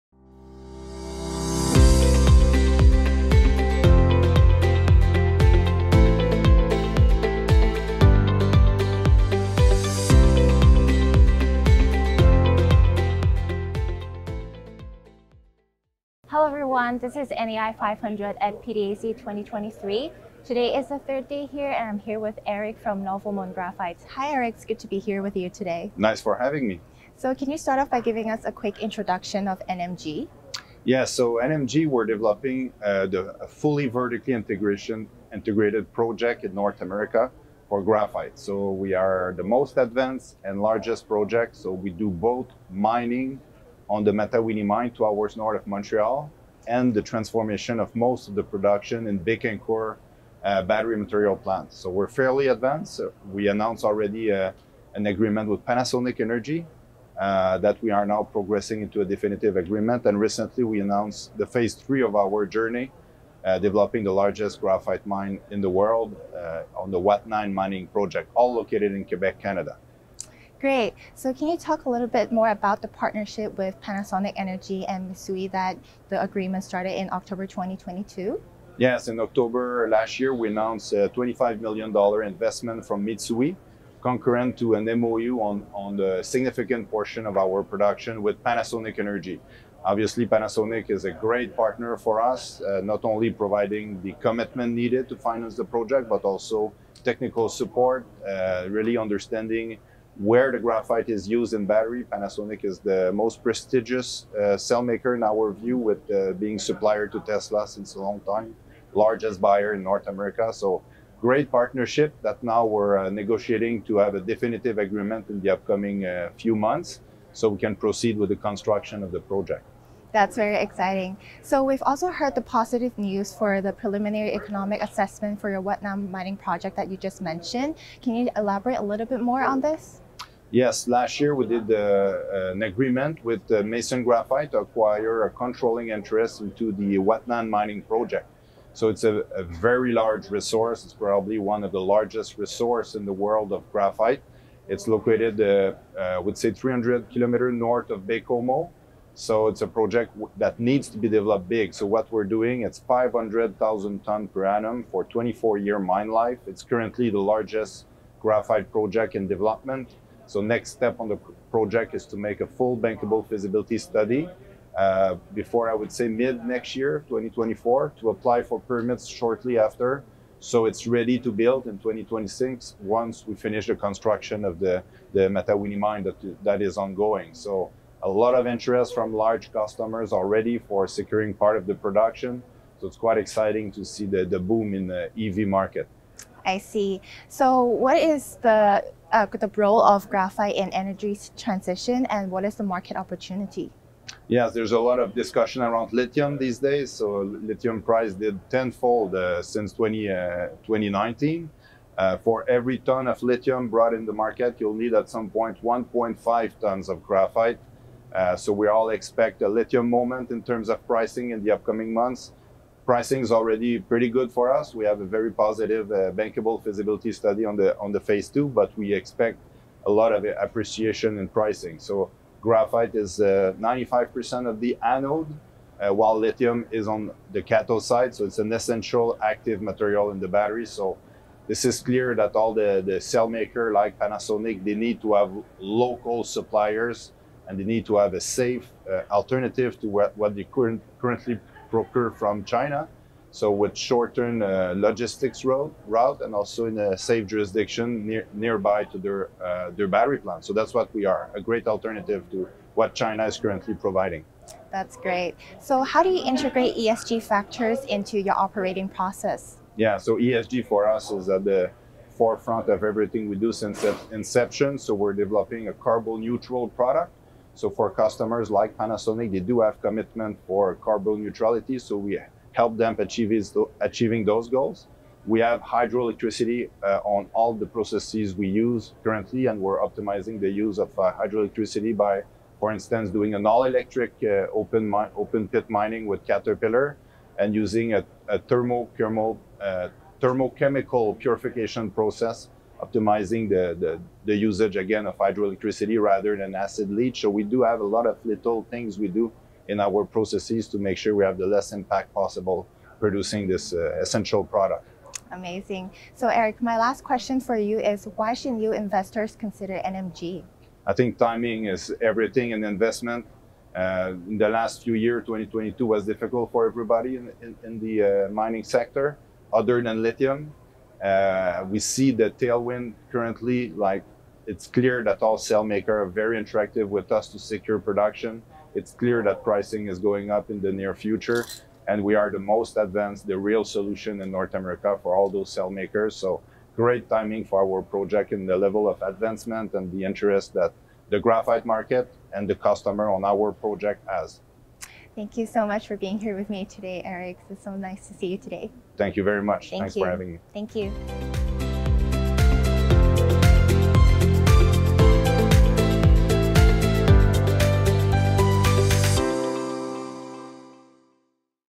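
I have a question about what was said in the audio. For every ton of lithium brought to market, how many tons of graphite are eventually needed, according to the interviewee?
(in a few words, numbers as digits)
1.5 tons.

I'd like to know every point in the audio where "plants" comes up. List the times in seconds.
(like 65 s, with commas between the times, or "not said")
51 s, 250 s.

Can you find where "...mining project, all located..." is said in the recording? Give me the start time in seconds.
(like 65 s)
67 s.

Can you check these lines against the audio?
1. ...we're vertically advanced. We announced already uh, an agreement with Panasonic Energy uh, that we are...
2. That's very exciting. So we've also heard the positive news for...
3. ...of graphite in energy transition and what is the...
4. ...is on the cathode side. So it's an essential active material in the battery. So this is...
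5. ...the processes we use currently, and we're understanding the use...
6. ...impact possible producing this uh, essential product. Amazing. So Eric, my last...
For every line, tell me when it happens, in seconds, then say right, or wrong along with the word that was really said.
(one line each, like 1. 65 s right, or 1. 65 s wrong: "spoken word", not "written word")
1. 51 s wrong: "fairly", not "vertically"
2. 120 s right
3. 189 s right
4. 226 s right
5. 277 s wrong: "optimizing", not "understanding"
6. 301 s right.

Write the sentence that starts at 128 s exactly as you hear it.
Can you elaborate a little bit more on this?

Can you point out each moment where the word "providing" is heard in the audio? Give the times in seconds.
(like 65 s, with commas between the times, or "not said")
93 s, 253 s.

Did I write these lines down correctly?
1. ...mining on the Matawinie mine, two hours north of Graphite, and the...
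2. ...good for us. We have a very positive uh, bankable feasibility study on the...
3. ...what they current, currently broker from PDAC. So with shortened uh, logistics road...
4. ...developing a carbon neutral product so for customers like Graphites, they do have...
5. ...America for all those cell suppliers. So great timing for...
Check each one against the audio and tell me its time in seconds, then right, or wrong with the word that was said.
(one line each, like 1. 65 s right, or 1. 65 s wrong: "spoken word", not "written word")
1. 42 s wrong: "Montreal", not "Graphite"
2. 214 s right
3. 240 s wrong: "China", not "PDAC"
4. 265 s wrong: "Panasonic", not "Graphites"
5. 334 s wrong: "makers", not "suppliers".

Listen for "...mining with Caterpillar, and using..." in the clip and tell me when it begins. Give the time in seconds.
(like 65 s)
285 s.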